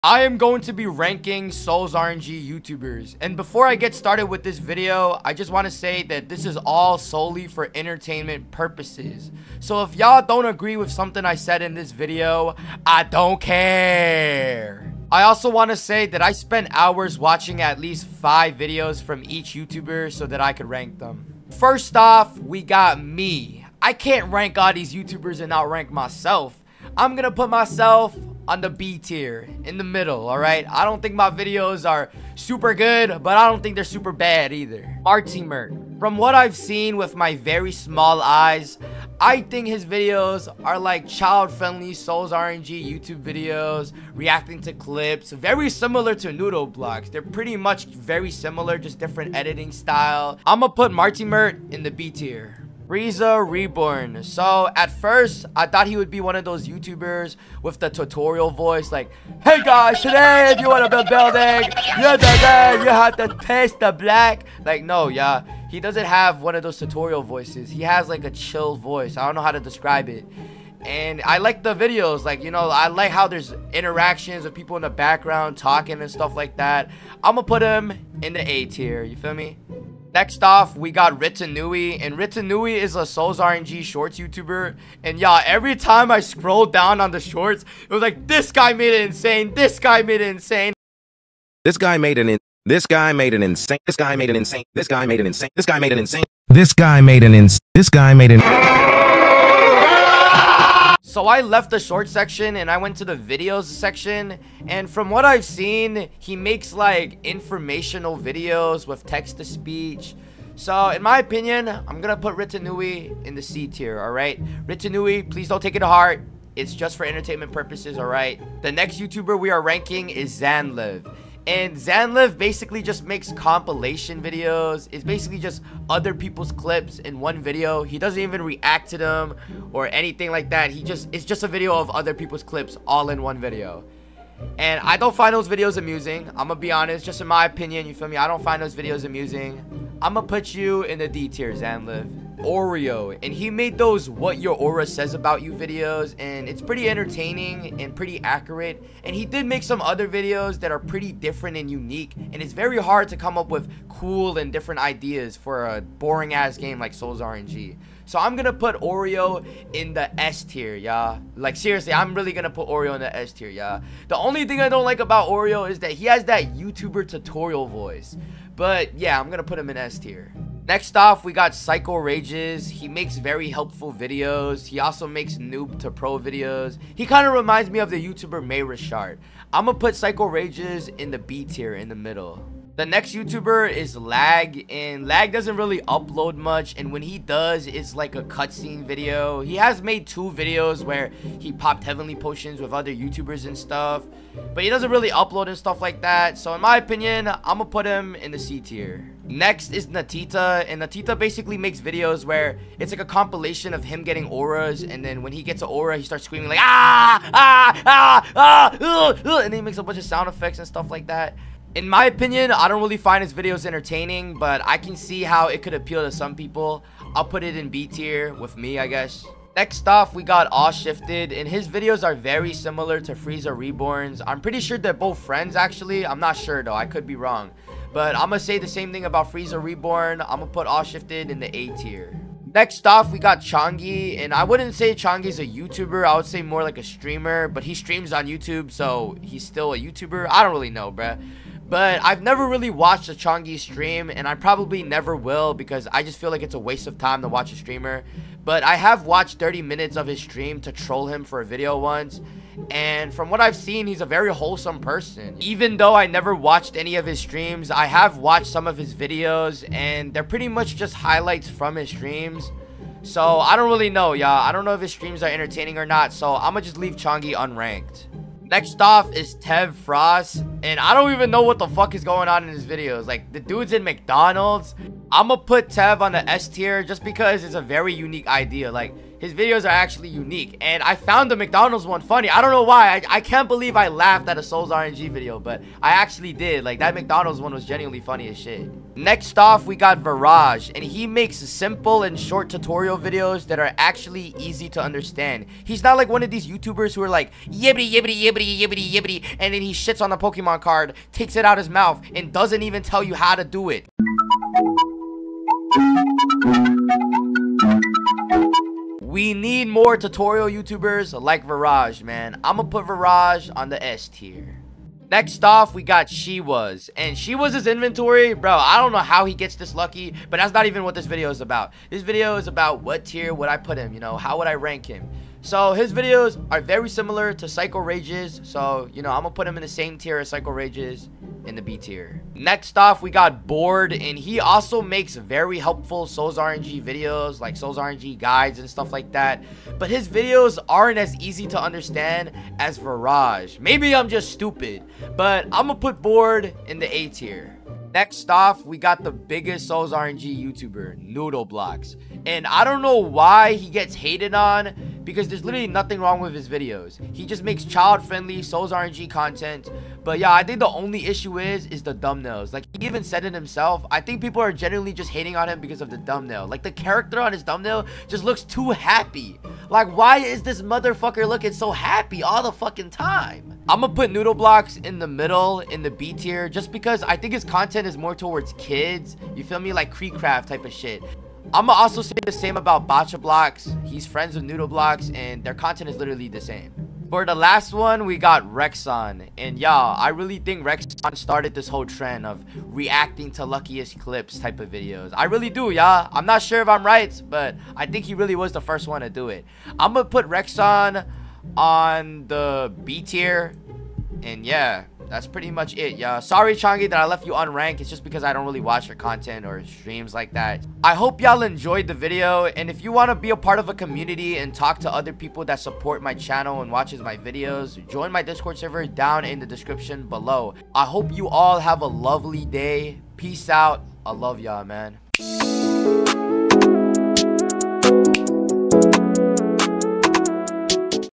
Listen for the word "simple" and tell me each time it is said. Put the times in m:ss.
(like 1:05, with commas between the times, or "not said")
4:51.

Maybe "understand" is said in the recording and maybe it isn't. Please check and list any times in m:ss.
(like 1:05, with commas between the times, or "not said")
4:54, 5:41.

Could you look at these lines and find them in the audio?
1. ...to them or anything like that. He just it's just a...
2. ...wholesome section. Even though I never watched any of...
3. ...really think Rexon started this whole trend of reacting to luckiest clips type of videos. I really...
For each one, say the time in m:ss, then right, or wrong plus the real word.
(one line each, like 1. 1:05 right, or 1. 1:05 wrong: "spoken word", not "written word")
1. 2:08 right
2. 4:14 wrong: "person", not "section"
3. 6:30 right.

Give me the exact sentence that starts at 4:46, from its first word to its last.
Like, that McDonald's one was genuinely funny as shit.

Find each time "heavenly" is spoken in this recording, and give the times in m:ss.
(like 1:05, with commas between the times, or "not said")
3:11.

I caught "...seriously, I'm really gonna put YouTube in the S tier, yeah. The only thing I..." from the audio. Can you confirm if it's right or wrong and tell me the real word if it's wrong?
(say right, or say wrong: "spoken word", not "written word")
wrong: "Oreo", not "YouTube".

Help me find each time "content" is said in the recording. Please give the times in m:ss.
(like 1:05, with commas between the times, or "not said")
5:59, 6:17, 6:25, 6:48.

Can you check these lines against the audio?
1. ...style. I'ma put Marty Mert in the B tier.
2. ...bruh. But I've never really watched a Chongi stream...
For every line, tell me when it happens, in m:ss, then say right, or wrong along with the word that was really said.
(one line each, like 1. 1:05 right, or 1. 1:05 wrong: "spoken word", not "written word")
1. 0:49 right
2. 4:00 right.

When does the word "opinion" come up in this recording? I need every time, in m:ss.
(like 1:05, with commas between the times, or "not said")
1:51, 2:17, 3:16, 3:32.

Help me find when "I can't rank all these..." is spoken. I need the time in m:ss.
0:23.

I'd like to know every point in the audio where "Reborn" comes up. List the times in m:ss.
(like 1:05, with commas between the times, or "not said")
0:53, 3:43, 3:49.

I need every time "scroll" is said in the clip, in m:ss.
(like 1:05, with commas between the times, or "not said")
1:26.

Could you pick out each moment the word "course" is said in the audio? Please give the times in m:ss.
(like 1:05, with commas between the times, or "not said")
not said.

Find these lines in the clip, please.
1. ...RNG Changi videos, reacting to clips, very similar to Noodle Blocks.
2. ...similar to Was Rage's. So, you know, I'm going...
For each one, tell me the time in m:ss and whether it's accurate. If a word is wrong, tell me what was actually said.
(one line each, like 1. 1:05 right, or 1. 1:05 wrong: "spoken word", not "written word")
1. 0:42 wrong: "YouTube", not "Changi"
2. 5:26 wrong: "Psycho", not "Was".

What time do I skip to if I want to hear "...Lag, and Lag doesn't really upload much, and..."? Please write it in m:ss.
3:03.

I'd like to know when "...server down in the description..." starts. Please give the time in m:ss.
6:58.